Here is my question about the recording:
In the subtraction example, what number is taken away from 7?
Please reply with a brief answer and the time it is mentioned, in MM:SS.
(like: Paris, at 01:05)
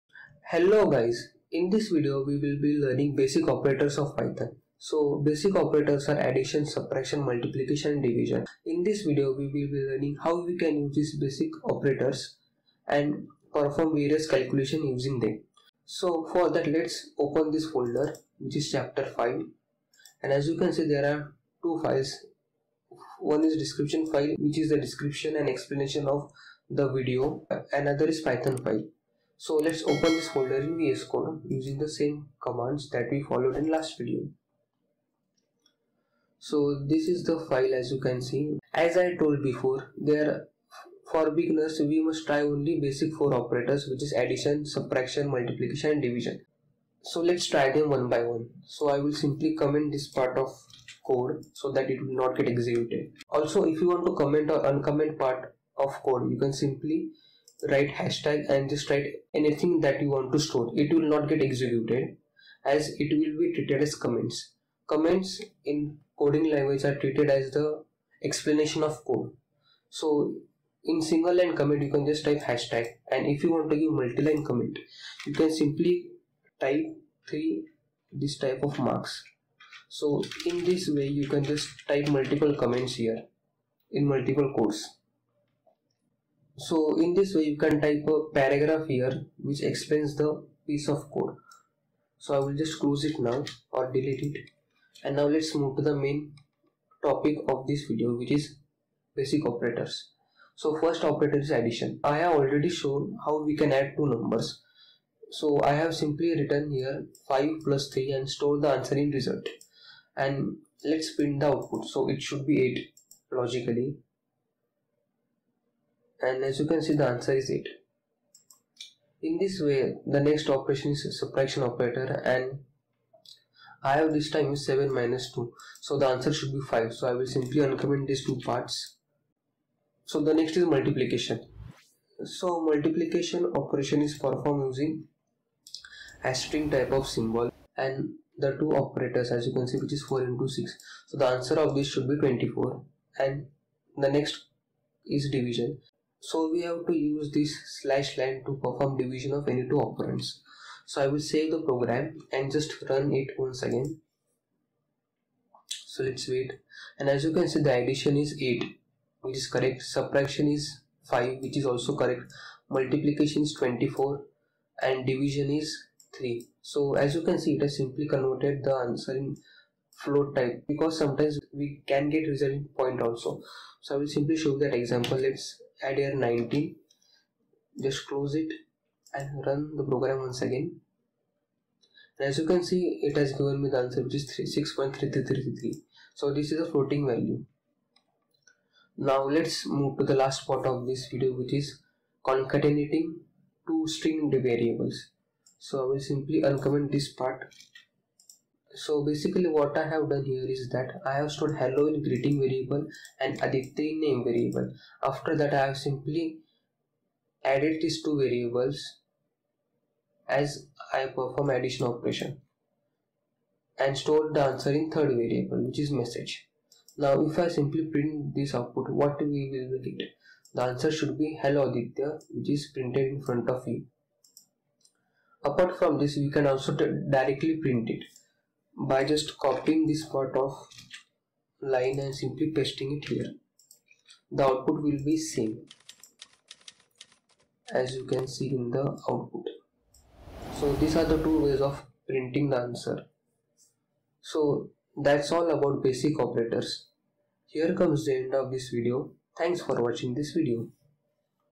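2, at 02:04.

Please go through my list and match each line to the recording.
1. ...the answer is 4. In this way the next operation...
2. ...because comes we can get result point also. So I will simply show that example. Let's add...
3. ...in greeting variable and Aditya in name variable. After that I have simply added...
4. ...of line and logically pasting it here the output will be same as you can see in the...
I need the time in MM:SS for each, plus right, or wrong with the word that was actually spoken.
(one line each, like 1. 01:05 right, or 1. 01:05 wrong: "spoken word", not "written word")
1. 01:56 wrong: "8", not "4"
2. 02:50 wrong: "sometimes", not "comes"
3. 03:21 right
4. 03:50 wrong: "simply", not "logically".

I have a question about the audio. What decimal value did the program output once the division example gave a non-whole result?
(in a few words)
6.3333.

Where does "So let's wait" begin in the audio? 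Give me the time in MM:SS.
02:35.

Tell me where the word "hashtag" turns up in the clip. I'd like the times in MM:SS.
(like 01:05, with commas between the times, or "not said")
00:57, 01:12.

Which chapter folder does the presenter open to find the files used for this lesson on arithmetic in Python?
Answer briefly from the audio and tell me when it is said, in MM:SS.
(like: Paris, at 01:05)
Chapter 5, at 00:18.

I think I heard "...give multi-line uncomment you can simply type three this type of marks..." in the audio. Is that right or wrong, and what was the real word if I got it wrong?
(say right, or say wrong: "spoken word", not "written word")
wrong: "comment", not "uncomment".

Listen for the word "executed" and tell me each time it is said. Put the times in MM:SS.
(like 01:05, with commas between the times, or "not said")
00:52, 01:01.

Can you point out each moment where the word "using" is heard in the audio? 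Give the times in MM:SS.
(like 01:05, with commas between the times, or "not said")
00:14, 00:31, 02:14.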